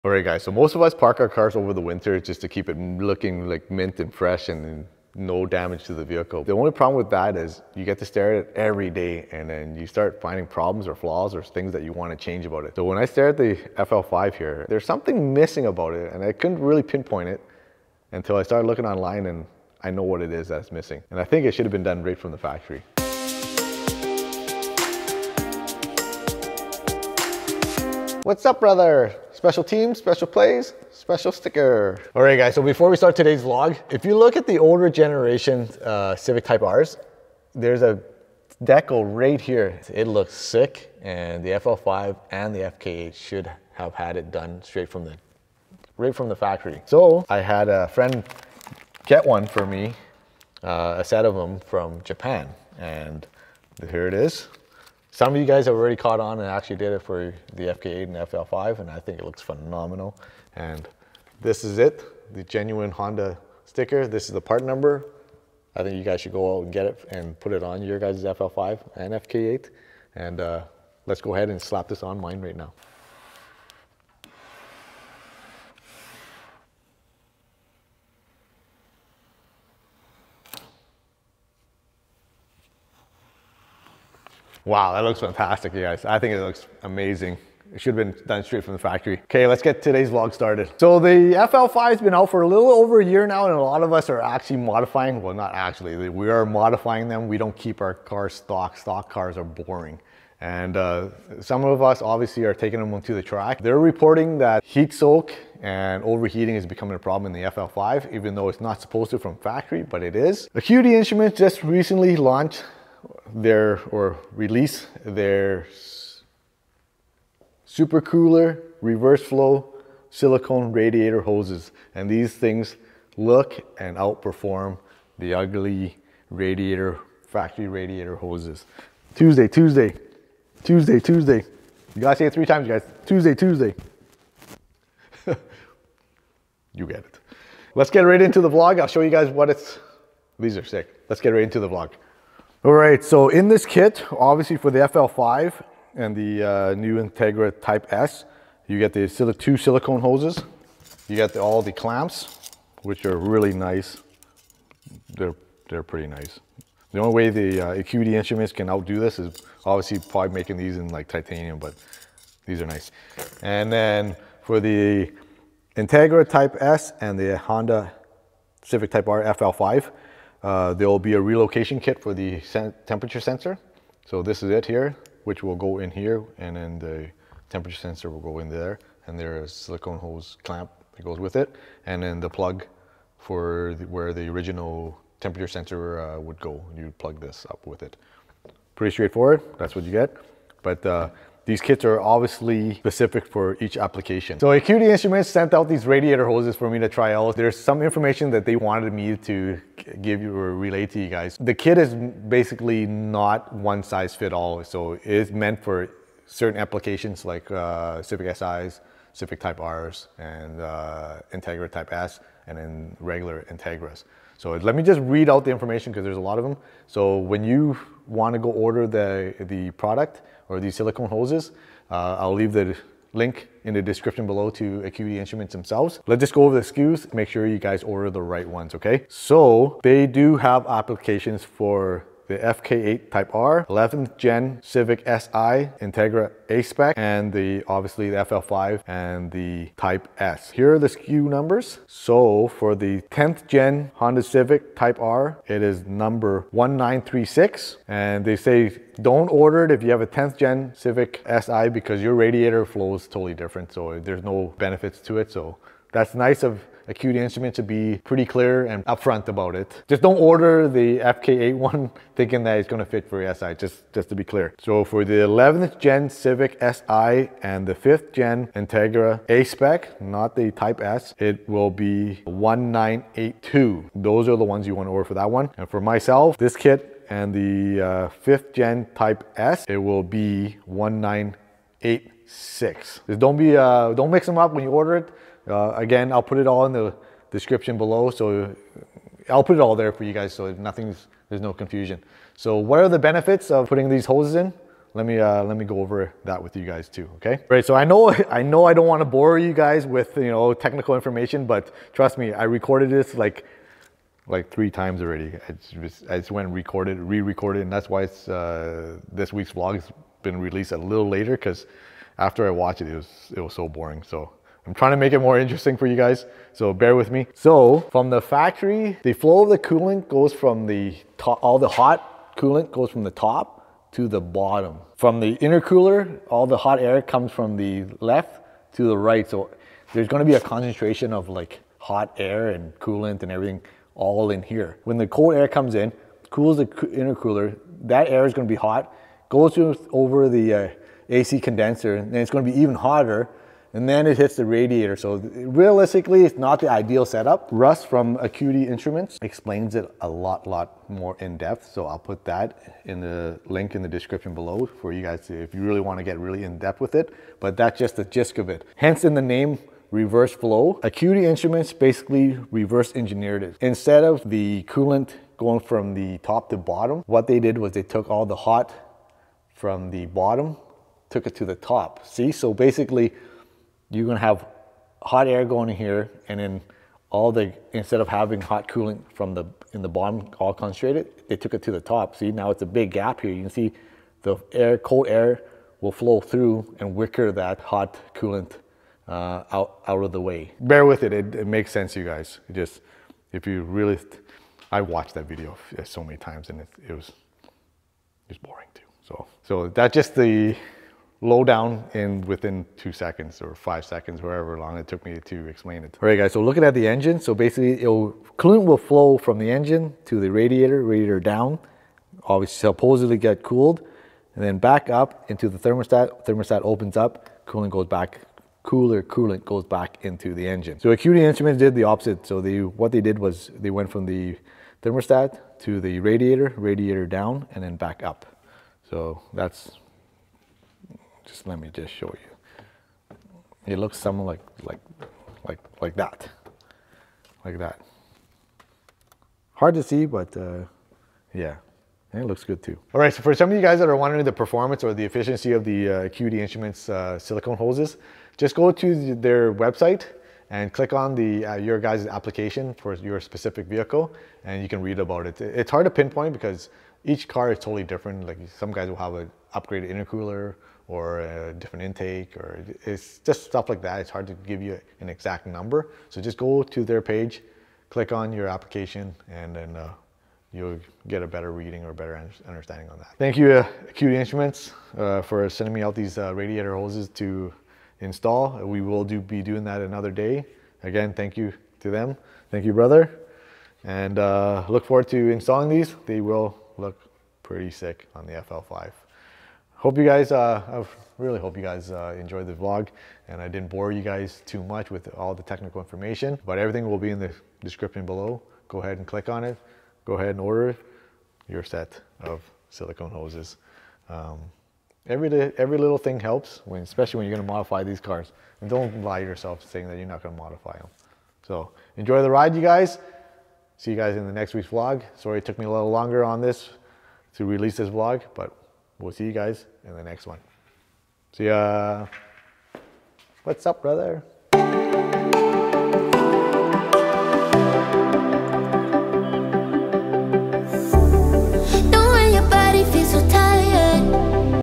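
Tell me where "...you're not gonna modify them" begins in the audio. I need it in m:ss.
8:29.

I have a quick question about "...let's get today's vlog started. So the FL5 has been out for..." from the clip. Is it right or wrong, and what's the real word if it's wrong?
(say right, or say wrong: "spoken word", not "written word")
right.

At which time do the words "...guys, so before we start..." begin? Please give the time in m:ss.
0:32.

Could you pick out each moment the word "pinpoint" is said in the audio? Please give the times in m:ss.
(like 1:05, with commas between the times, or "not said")
0:16, 7:35.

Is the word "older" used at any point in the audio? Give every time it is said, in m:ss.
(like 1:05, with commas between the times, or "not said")
0:34.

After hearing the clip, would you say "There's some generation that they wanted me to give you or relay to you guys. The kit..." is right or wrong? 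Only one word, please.
wrong.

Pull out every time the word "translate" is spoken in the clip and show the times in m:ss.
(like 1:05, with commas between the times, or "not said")
not said.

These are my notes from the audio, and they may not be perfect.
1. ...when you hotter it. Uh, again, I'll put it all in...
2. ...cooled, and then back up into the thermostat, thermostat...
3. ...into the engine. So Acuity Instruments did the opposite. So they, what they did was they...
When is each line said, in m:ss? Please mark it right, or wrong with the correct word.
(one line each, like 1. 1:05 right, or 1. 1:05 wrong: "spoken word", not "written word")
1. 4:44 wrong: "order", not "hotter"
2. 6:53 right
3. 7:00 right.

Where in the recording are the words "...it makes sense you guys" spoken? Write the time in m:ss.
6:31.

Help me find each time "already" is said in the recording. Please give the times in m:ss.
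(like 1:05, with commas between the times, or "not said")
0:55, 5:05.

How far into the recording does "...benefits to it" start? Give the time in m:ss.
4:14.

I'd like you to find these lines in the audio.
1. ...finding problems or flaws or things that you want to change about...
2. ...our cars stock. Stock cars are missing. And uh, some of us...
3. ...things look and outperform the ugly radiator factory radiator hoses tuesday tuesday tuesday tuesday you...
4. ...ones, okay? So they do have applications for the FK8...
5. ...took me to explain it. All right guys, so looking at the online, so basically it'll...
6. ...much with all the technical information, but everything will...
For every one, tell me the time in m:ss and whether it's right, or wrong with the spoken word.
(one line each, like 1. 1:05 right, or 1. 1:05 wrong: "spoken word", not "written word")
1. 0:10 right
2. 1:37 wrong: "boring", not "missing"
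3. 2:02 right
4. 3:48 right
5. 6:44 wrong: "engine", not "online"
6. 8:14 right.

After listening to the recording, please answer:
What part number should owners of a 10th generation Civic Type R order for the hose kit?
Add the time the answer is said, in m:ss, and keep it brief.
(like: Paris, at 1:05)
1936, at 4:06.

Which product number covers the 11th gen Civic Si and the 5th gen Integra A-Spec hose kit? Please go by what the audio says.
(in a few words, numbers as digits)
1982.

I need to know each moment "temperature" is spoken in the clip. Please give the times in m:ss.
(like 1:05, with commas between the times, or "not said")
2:52, 2:57, 3:05.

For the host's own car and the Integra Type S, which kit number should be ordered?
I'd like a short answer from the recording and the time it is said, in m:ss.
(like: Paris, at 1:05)
1986, at 4:40.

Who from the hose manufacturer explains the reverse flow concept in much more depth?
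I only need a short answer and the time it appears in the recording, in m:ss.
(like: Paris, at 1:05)
Russ, at 5:47.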